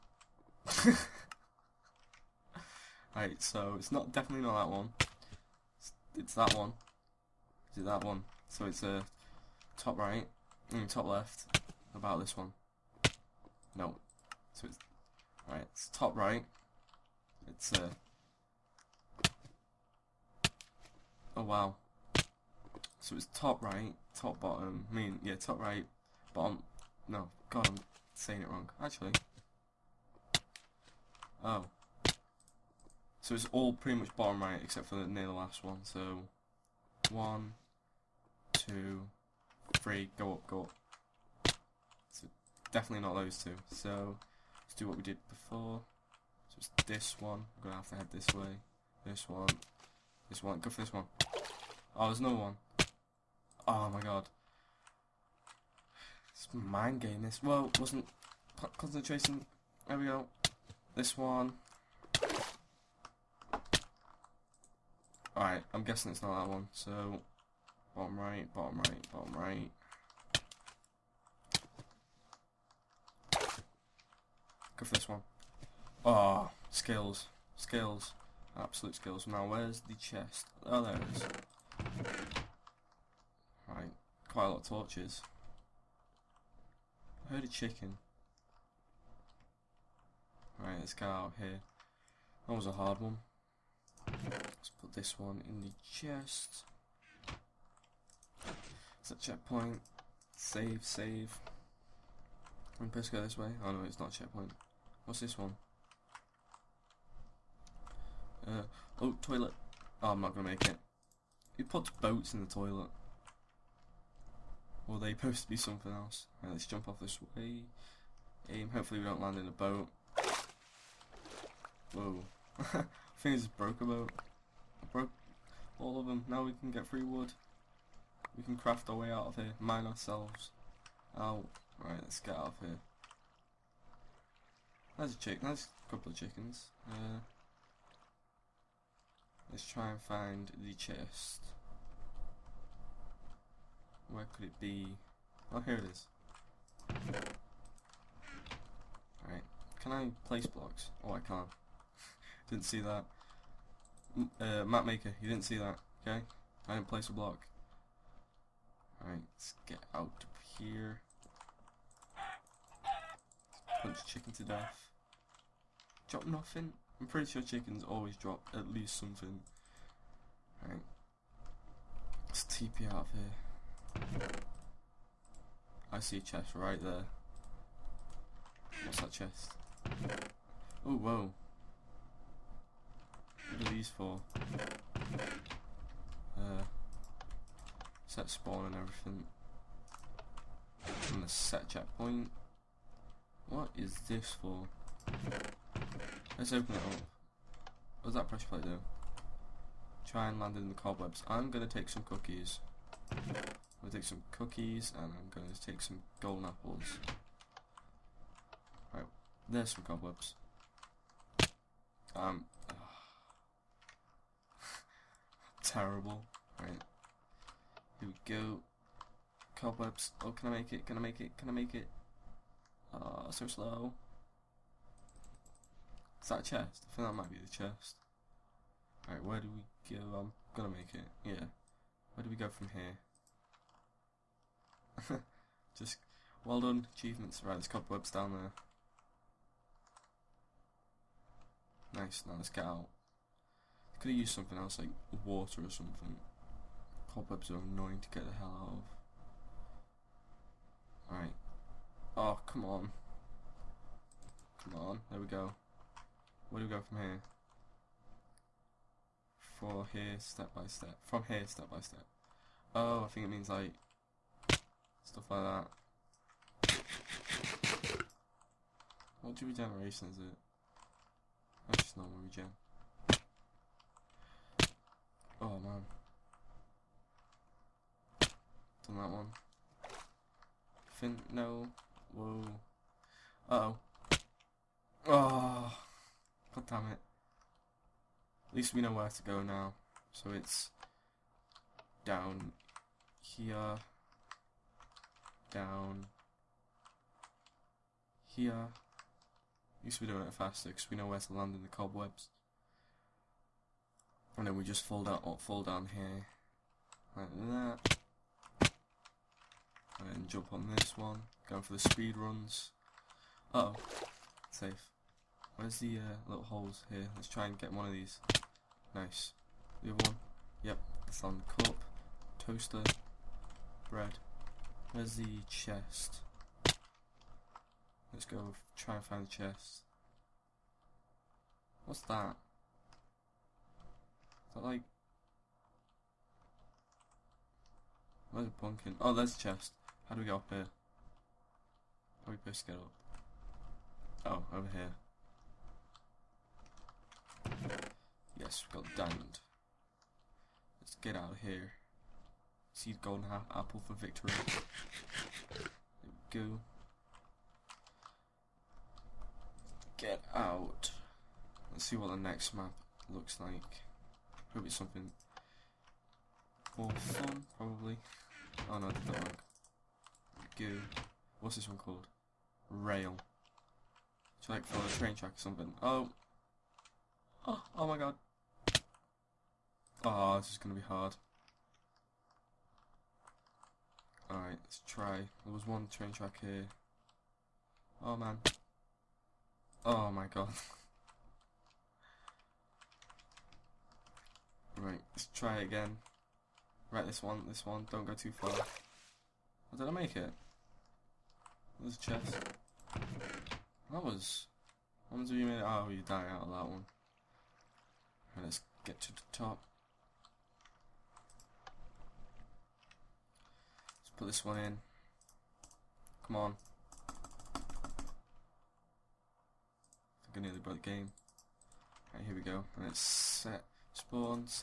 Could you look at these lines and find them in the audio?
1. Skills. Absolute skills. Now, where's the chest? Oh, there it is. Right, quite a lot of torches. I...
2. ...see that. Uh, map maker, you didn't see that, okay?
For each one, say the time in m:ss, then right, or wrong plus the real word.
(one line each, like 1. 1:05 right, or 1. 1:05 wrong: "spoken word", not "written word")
1. 1:17 right
2. 2:32 right.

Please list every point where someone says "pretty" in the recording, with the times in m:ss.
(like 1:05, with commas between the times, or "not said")
0:33, 2:47.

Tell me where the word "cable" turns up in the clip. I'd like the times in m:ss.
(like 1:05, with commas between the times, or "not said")
not said.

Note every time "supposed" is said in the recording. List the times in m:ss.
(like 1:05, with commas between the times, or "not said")
1:42, 1:55.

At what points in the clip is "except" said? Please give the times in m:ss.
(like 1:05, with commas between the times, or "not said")
0:34.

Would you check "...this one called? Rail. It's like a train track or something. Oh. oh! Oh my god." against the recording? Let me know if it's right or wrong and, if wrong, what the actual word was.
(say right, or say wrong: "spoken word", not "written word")
right.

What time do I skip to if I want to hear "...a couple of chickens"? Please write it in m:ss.
2:15.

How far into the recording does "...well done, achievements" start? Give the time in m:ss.
3:56.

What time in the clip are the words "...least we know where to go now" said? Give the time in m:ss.
4:48.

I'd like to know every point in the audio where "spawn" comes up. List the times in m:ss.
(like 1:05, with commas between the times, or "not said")
3:08, 7:03.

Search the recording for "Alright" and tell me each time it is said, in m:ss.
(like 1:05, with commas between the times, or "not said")
1:05, 2:29, 2:39, 3:49, 4:11, 6:24.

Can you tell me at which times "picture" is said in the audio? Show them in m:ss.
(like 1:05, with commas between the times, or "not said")
not said.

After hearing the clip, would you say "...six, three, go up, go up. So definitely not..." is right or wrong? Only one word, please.
wrong.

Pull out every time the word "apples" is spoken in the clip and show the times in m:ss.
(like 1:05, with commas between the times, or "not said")
3:26, 5:53.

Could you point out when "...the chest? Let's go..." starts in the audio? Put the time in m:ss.
5:25.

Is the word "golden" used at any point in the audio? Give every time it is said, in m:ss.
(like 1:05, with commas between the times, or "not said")
3:26, 5:52.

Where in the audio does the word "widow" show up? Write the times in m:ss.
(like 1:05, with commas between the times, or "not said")
not said.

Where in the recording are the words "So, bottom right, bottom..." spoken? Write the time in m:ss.
1:06.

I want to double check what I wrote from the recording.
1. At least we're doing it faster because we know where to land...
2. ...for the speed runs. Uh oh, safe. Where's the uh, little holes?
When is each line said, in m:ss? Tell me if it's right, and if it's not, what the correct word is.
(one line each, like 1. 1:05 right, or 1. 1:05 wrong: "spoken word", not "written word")
1. 4:58 right
2. 5:11 right.